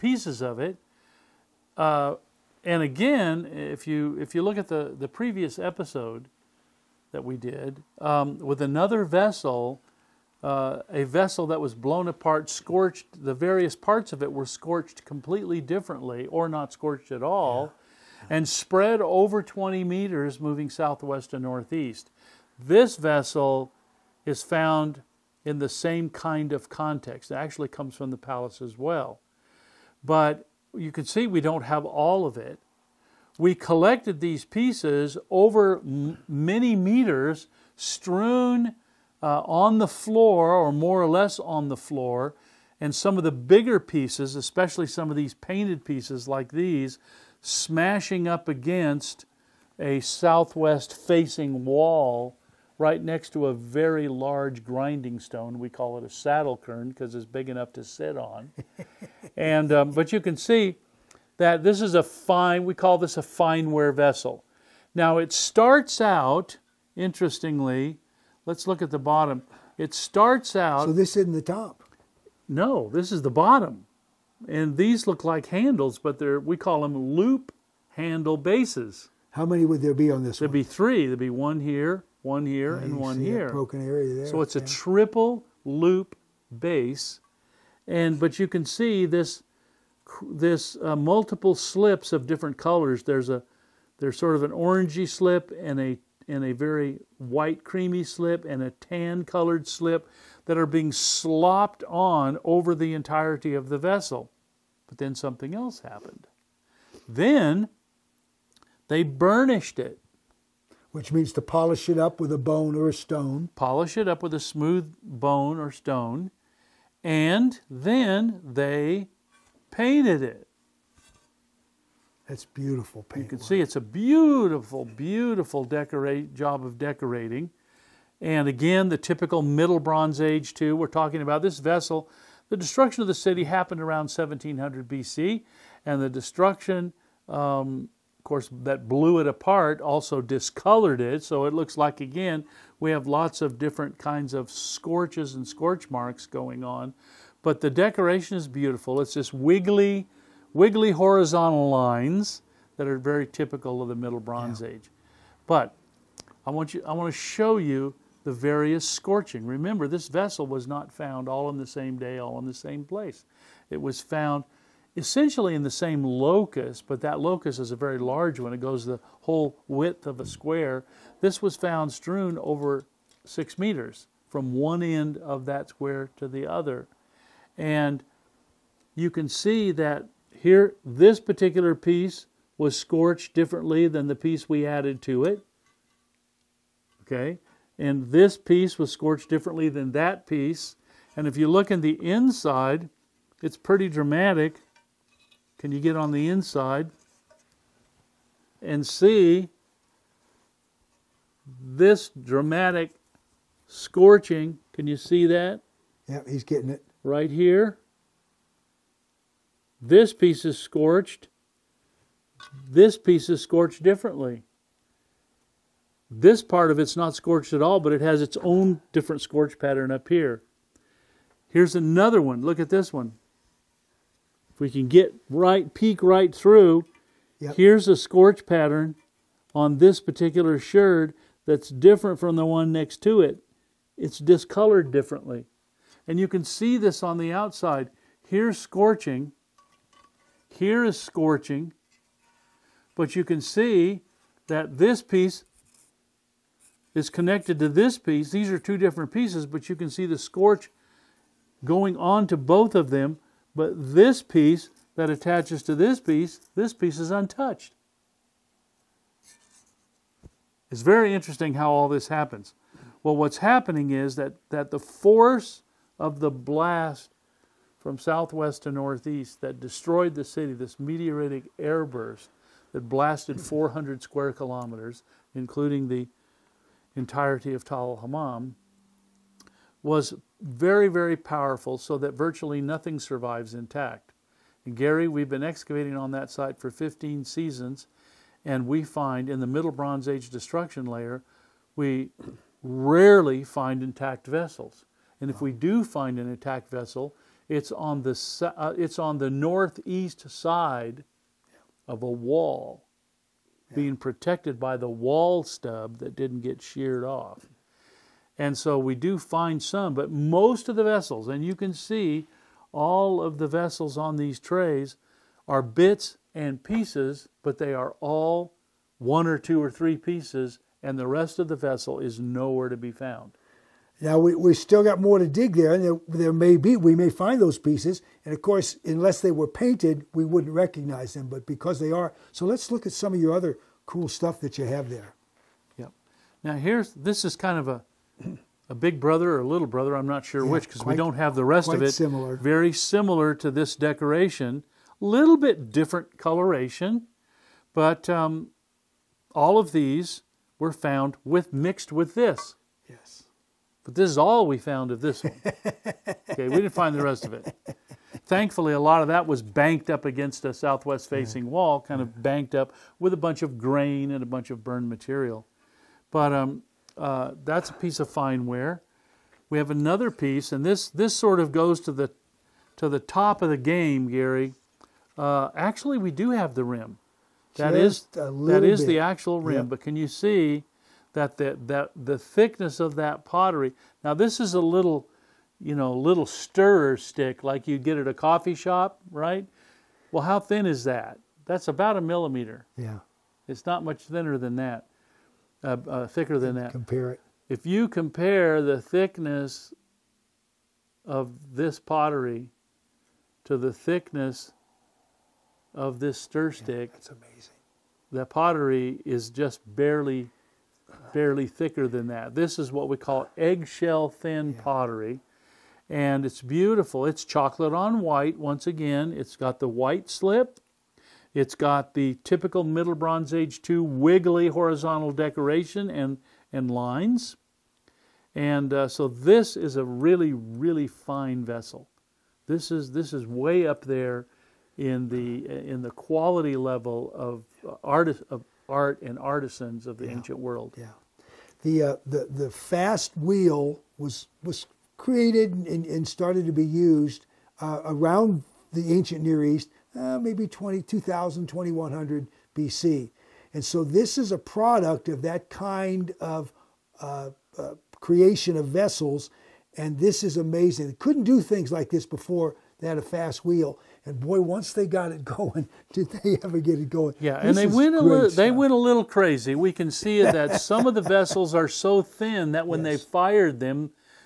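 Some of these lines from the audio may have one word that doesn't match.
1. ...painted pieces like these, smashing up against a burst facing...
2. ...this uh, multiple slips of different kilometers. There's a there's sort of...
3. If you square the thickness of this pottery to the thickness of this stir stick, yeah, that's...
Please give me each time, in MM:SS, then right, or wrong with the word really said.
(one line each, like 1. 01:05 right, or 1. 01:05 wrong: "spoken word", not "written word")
1. 00:45 wrong: "southwest", not "burst"
2. 01:30 wrong: "colors", not "kilometers"
3. 06:37 wrong: "compare", not "square".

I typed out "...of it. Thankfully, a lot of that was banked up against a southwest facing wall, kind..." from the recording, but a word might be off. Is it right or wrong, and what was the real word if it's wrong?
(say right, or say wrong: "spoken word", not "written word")
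right.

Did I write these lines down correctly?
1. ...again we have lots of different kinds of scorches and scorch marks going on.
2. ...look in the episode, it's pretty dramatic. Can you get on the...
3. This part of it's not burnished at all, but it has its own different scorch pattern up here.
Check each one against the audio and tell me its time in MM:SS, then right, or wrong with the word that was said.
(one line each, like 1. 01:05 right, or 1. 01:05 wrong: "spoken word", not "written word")
1. 02:22 right
2. 03:11 wrong: "inside", not "episode"
3. 03:36 wrong: "scorched", not "burnished".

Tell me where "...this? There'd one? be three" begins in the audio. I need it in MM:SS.
01:20.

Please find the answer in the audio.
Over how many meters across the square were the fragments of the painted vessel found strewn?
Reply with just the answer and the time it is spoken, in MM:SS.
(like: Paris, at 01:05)
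6 meters, at 02:53.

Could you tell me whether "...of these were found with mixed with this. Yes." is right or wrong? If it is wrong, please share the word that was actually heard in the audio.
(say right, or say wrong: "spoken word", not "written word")
right.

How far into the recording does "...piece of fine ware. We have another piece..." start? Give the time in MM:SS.
06:07.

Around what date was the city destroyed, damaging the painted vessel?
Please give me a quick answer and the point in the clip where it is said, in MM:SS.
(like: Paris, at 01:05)
1700 BC, at 02:14.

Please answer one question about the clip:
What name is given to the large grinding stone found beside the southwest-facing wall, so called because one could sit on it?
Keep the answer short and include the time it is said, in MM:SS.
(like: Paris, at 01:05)
saddle quern, at 00:56.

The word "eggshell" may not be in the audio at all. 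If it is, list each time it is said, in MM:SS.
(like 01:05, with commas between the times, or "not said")
06:53.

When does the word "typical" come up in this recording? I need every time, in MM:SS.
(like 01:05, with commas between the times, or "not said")
02:08, 02:33, 07:02.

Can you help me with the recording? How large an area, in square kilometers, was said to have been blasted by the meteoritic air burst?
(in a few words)
400 square kilometers.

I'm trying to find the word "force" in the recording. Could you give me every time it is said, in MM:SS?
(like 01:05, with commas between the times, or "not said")
04:24.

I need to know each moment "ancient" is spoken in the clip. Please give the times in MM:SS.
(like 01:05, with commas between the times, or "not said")
07:20, 07:28.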